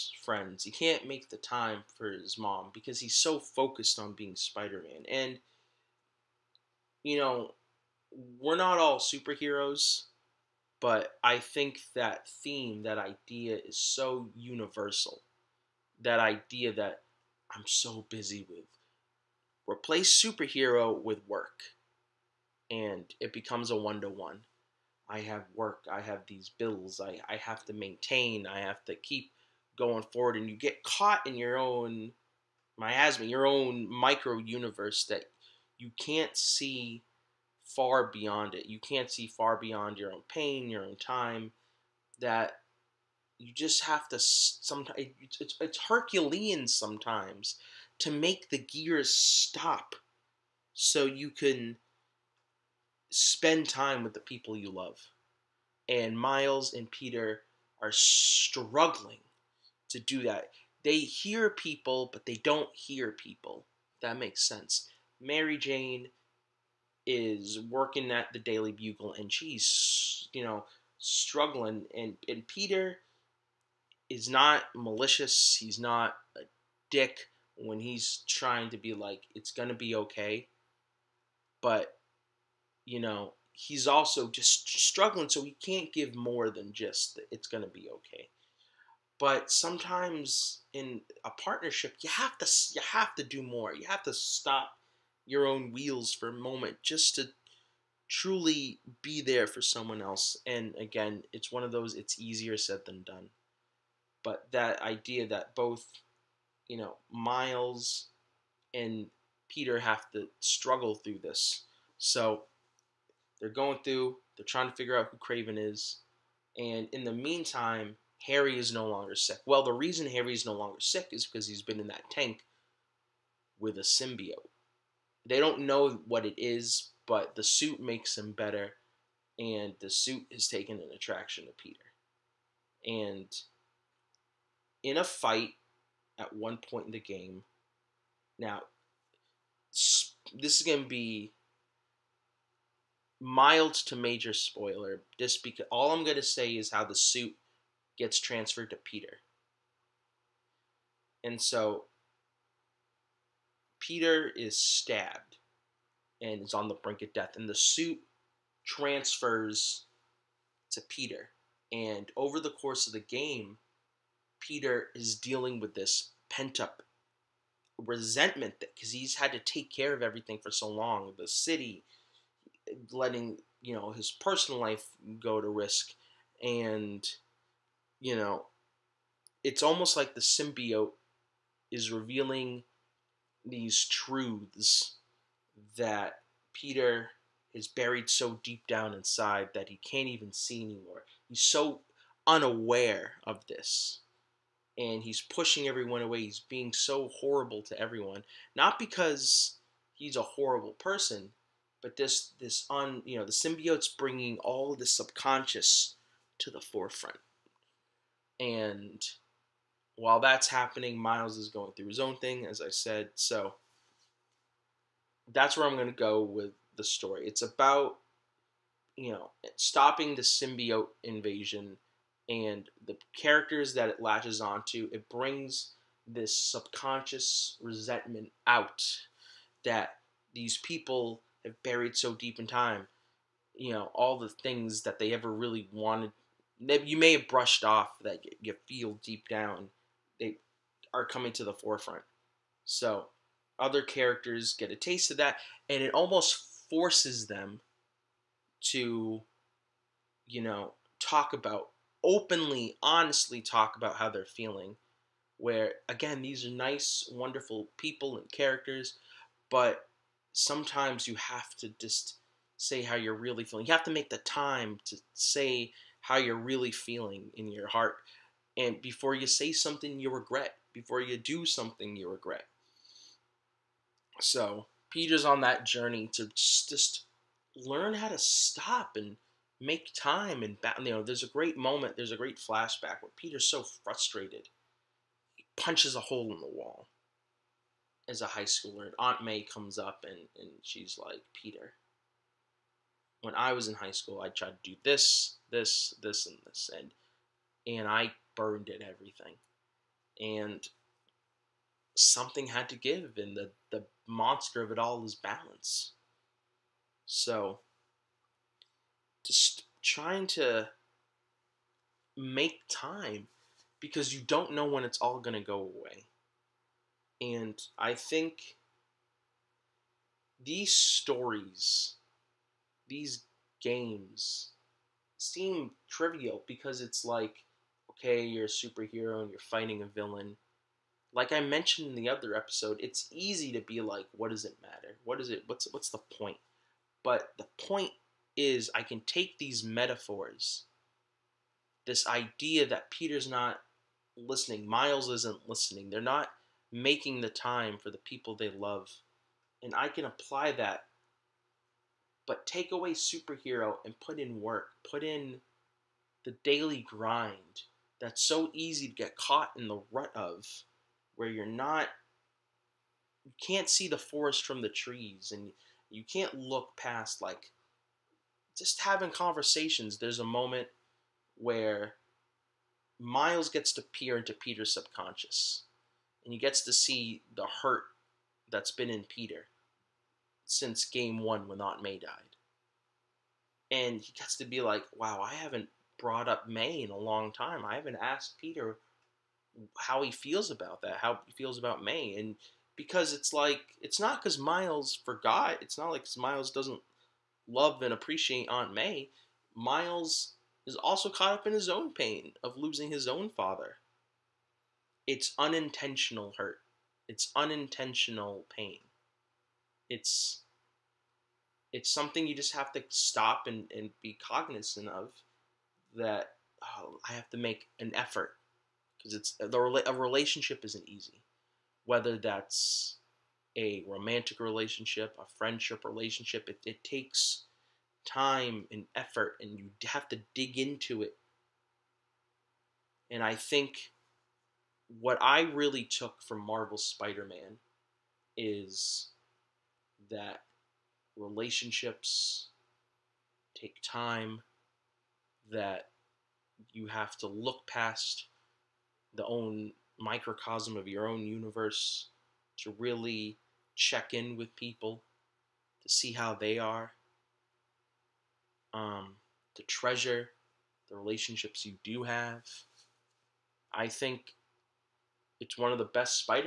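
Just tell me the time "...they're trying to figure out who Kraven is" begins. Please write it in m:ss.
1:54.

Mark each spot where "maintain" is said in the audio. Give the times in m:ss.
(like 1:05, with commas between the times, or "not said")
0:27.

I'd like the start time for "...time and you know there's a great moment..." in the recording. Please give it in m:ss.
4:39.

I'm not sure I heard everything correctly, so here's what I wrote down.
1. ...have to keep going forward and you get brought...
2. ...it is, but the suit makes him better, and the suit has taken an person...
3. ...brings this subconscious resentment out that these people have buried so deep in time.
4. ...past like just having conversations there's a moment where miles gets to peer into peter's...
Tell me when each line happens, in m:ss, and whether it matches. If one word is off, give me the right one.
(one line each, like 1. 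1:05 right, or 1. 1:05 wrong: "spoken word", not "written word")
1. 0:28 wrong: "caught", not "brought"
2. 2:06 wrong: "attraction", not "person"
3. 3:45 right
4. 6:06 right.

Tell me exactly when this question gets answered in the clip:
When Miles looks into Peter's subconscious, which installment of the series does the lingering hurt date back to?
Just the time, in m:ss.
6:20.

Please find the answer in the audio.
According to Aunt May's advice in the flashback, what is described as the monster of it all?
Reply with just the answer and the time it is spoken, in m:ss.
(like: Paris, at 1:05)
Balance, at 5:05.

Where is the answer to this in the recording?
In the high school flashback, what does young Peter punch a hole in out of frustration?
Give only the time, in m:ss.
4:46.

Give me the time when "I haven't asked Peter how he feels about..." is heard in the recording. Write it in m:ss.
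6:27.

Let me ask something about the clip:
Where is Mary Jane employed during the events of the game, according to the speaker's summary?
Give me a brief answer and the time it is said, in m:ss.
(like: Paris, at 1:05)
The Daily Bugle, at 1:08.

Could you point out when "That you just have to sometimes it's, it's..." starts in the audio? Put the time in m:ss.
0:42.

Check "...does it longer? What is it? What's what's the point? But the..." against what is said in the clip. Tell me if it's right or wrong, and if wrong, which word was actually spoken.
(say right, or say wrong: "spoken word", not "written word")
wrong: "matter", not "longer".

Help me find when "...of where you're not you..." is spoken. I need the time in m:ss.
6:00.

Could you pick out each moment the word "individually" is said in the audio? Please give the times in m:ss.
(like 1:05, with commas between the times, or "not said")
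not said.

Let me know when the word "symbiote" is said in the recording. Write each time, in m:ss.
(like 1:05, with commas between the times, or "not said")
2:03, 3:00, 3:23, 3:40.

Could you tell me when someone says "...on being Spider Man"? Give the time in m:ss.
0:03.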